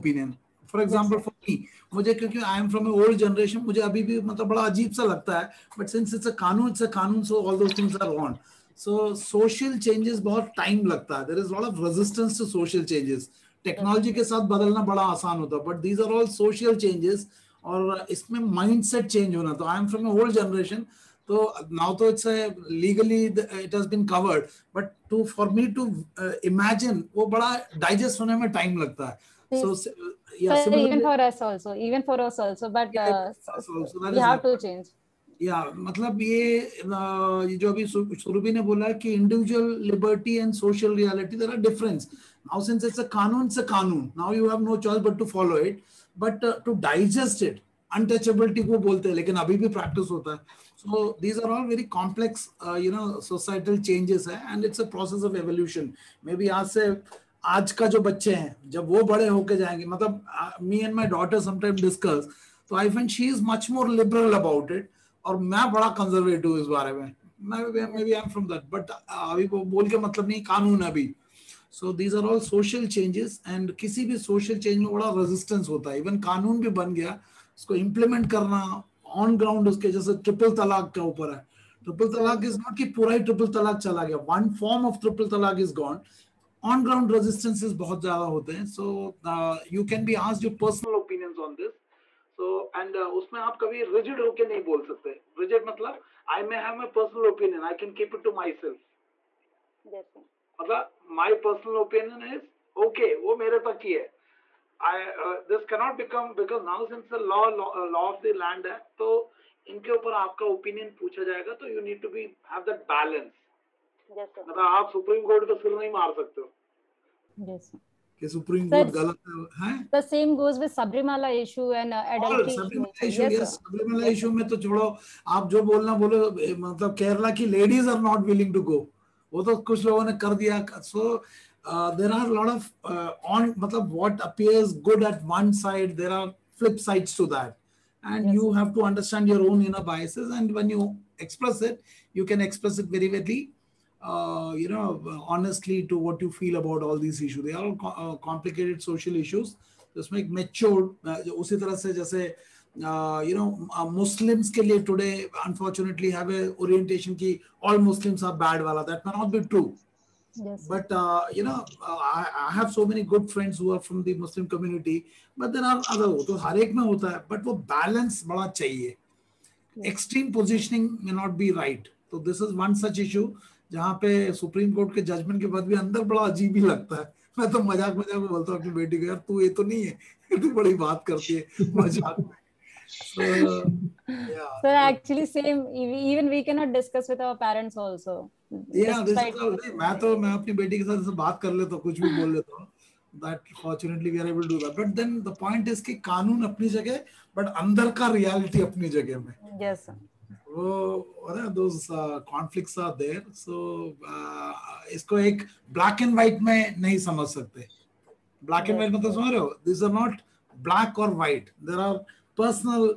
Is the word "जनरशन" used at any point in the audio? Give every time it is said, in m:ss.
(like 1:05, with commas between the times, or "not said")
0:03, 0:20.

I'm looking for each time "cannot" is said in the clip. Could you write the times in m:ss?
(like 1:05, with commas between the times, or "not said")
1:45, 3:06.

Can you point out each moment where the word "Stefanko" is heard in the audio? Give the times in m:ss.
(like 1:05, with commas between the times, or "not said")
not said.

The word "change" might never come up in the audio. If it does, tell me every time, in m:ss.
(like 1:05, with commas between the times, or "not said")
0:34.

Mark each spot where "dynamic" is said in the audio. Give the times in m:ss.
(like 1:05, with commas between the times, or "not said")
not said.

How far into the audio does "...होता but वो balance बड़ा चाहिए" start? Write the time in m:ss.
2:46.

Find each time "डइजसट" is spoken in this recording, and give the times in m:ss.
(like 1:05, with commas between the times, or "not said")
0:27, 0:46.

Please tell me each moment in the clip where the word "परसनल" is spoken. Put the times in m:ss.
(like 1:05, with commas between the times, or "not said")
1:30, 1:36, 1:41, 3:32.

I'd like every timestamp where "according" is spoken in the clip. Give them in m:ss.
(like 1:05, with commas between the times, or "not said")
not said.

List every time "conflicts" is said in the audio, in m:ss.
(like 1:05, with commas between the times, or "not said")
3:22.